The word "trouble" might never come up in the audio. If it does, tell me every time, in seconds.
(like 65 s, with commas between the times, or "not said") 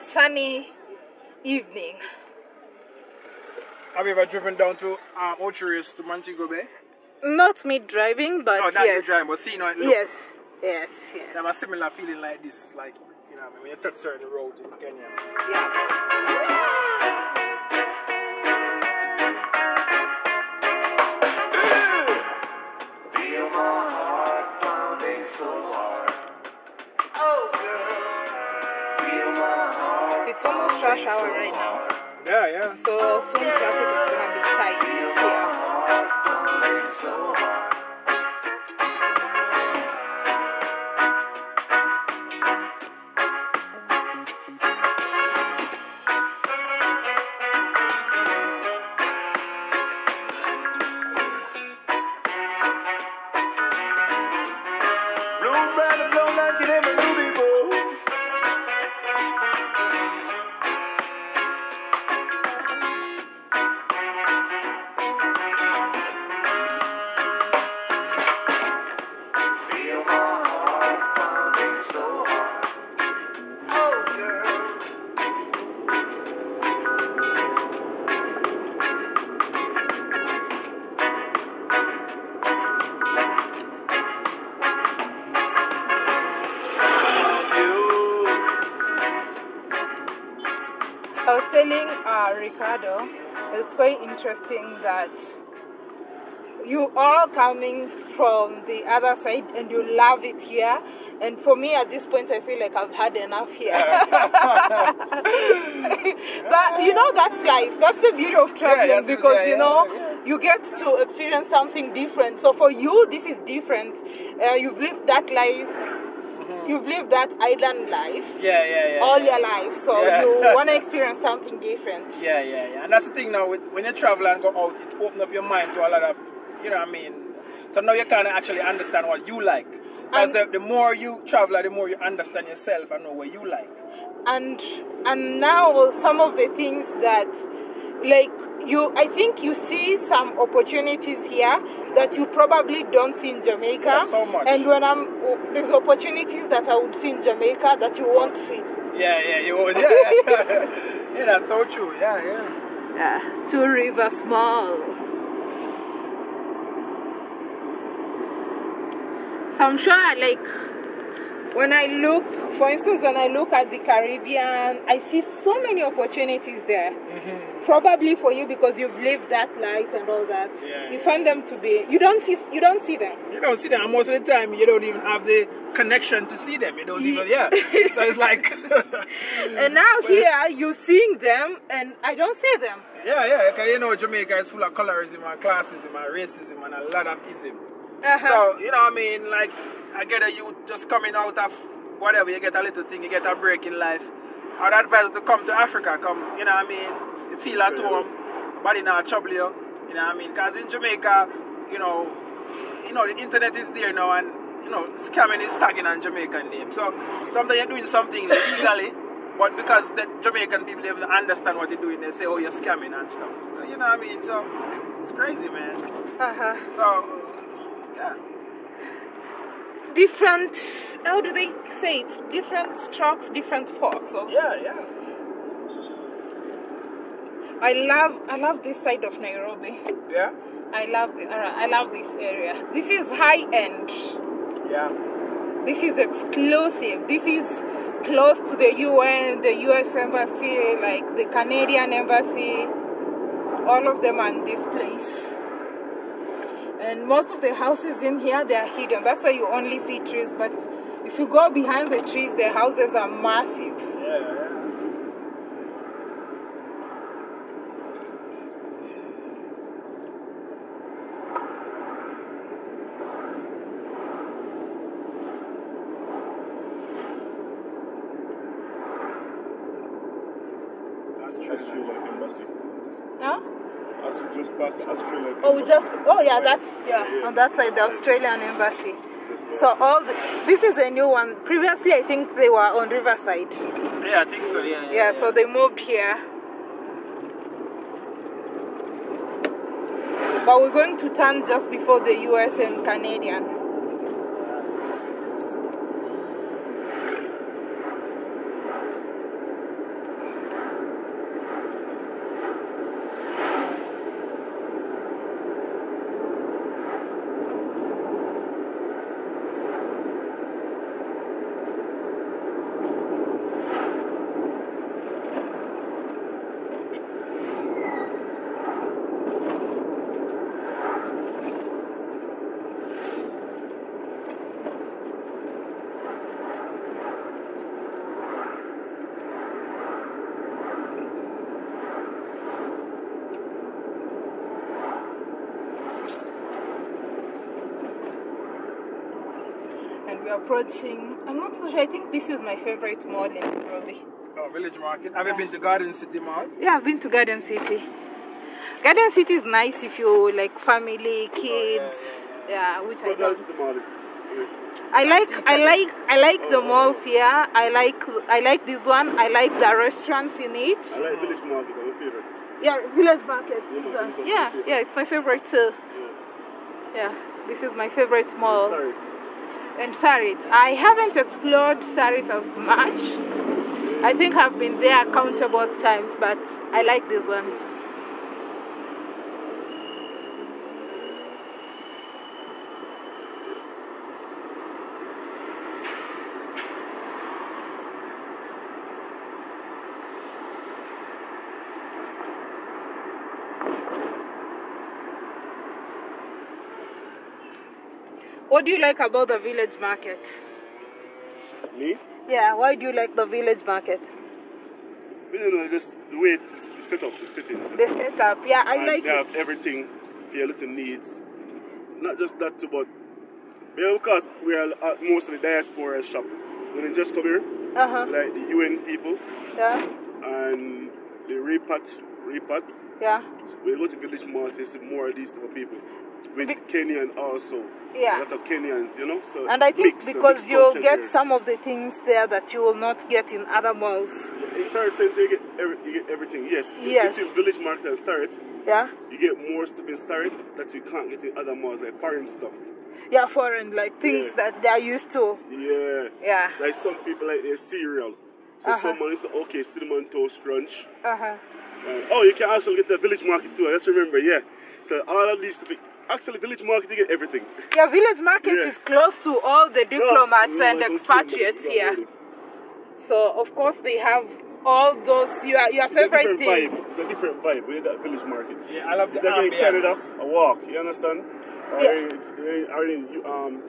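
199 s.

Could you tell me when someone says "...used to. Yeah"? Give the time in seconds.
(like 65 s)
444 s.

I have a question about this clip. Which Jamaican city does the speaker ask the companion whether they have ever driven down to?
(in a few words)
Montego Bay.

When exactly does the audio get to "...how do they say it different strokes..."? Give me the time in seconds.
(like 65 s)
221 s.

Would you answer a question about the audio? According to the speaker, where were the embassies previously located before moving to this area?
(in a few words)
Riverside.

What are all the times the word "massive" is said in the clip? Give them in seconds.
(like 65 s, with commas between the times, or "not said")
253 s.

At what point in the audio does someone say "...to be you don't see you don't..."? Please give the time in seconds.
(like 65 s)
171 s.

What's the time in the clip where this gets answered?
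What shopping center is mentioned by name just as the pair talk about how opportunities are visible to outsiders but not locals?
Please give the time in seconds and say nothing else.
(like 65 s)
153 s.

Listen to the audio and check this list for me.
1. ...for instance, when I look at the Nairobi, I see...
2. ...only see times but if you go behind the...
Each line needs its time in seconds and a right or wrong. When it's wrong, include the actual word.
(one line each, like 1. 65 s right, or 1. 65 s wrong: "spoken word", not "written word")
1. 162 s wrong: "Caribbean", not "Nairobi"
2. 249 s wrong: "trees", not "times".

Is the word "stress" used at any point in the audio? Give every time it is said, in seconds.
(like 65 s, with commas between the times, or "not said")
not said.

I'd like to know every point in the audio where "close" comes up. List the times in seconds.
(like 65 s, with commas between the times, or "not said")
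238 s, 458 s.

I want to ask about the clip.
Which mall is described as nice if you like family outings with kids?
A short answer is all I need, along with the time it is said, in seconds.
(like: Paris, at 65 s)
Garden City Mall, at 345 s.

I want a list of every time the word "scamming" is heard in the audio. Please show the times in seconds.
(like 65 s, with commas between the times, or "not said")
204 s, 212 s.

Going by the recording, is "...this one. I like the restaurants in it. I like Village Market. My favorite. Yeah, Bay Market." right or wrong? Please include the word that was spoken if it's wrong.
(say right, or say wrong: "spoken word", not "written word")
wrong: "Village", not "Bay".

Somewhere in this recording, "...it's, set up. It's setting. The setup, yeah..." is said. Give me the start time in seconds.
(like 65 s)
406 s.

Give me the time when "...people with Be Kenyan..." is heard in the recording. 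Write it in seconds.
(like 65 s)
425 s.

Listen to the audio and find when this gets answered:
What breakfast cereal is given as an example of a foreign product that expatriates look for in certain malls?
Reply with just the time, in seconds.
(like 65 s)
449 s.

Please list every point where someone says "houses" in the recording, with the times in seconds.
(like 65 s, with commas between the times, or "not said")
247 s, 252 s.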